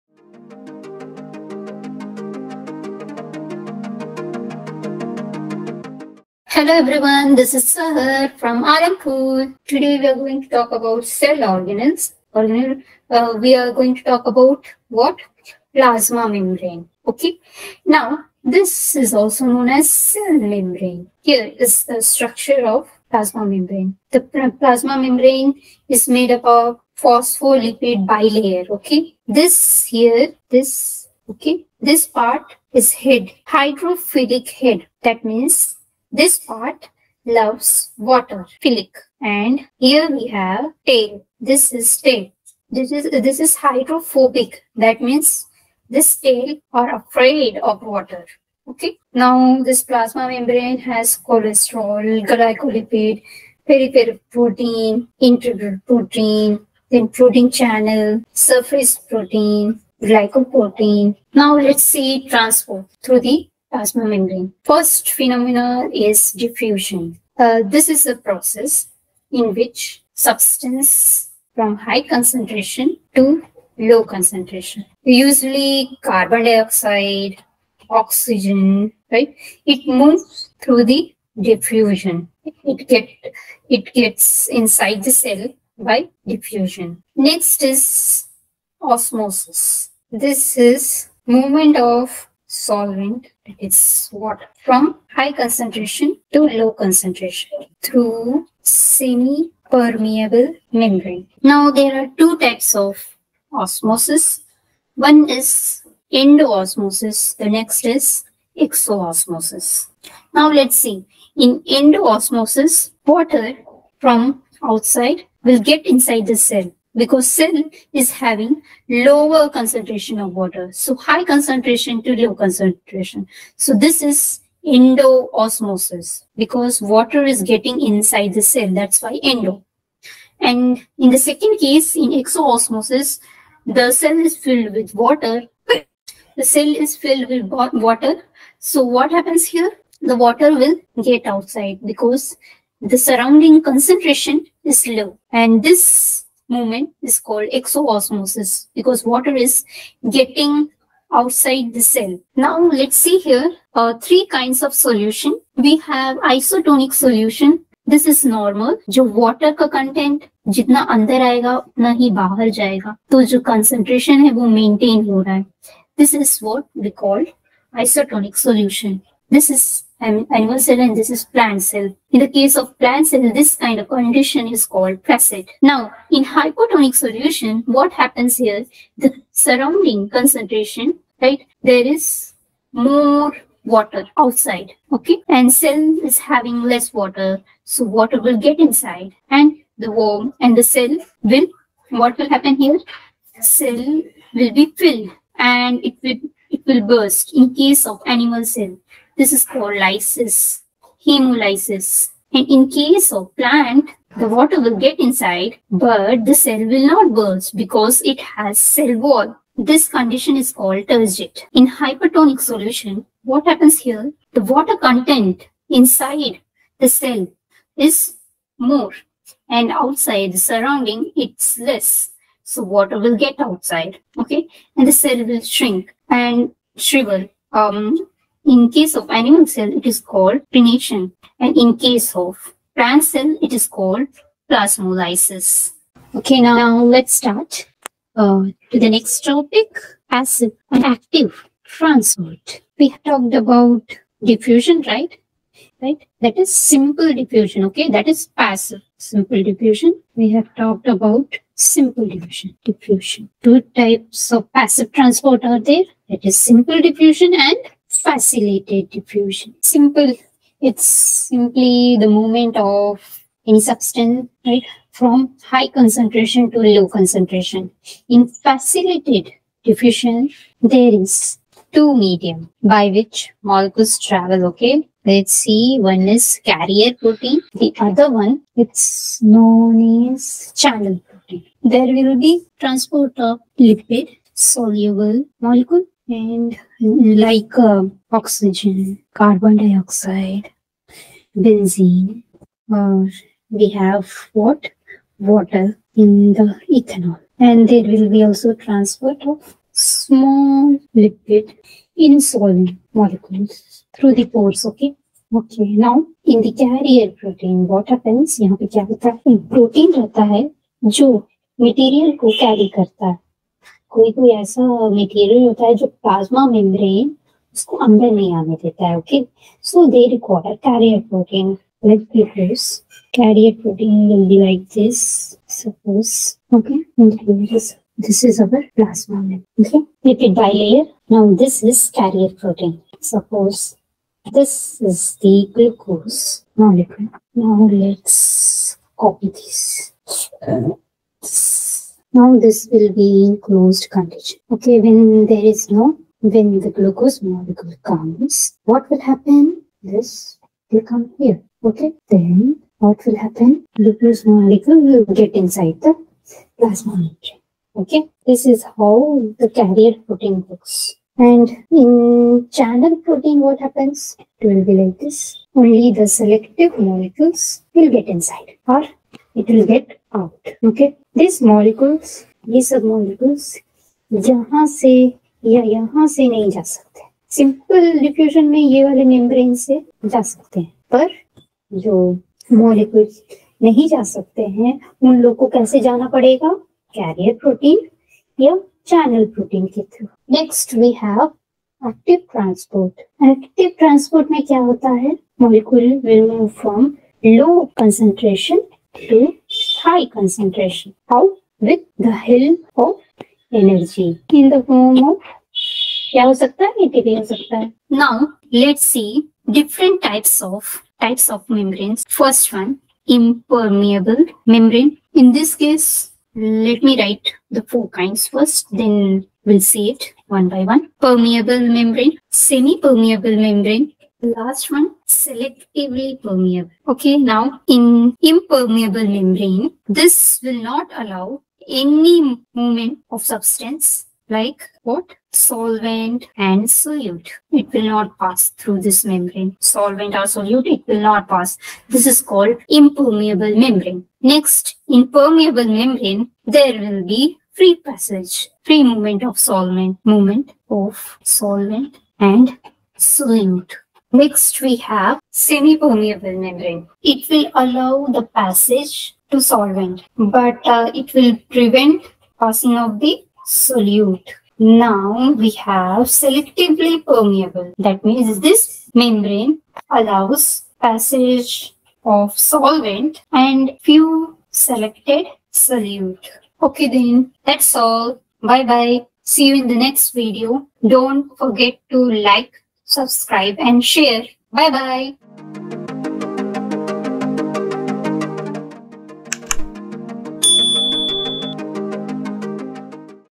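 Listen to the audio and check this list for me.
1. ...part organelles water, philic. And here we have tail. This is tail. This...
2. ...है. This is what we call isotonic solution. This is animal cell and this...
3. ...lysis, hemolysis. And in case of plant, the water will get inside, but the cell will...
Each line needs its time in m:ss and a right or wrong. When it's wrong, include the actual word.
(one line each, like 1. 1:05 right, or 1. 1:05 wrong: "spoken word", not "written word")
1. 0:36 wrong: "loves", not "organelles"
2. 2:45 right
3. 3:19 right.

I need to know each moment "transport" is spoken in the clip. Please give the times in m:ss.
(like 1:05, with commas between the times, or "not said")
1:02, 4:01, 4:14, 4:42, 4:58.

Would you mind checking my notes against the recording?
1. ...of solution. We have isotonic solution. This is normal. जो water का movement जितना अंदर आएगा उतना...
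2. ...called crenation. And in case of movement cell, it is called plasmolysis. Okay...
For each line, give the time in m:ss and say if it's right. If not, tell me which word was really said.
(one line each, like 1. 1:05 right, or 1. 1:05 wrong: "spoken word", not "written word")
1. 2:34 wrong: "content", not "movement"
2. 3:49 wrong: "plant", not "movement".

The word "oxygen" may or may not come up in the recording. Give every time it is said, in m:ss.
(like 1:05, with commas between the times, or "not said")
1:17, 4:48.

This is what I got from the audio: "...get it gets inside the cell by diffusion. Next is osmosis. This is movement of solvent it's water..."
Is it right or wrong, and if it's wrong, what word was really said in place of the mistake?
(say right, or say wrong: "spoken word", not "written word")
right.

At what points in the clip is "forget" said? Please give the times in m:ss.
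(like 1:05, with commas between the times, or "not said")
8:01.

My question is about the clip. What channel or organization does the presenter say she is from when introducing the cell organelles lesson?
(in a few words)
AlamKul.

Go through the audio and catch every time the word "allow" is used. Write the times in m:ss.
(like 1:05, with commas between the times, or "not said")
7:10, 7:37, 7:49.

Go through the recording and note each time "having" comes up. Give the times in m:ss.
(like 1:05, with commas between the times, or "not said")
1:58, 3:06.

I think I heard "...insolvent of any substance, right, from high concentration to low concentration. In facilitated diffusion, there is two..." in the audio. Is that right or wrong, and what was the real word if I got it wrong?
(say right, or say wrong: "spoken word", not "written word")
wrong: "movement", not "insolvent".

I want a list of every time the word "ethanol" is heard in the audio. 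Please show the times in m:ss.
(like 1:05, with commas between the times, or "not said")
4:56.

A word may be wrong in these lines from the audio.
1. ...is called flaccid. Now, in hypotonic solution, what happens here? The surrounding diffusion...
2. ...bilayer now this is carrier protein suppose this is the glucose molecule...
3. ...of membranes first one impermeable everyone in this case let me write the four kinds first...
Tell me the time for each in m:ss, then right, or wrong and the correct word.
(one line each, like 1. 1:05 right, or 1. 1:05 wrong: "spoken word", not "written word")
1. 2:54 wrong: "concentration", not "diffusion"
2. 5:30 right
3. 6:51 wrong: "membrane", not "everyone".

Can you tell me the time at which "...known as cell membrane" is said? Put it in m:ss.
0:19.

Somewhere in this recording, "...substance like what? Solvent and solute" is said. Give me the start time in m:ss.
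7:13.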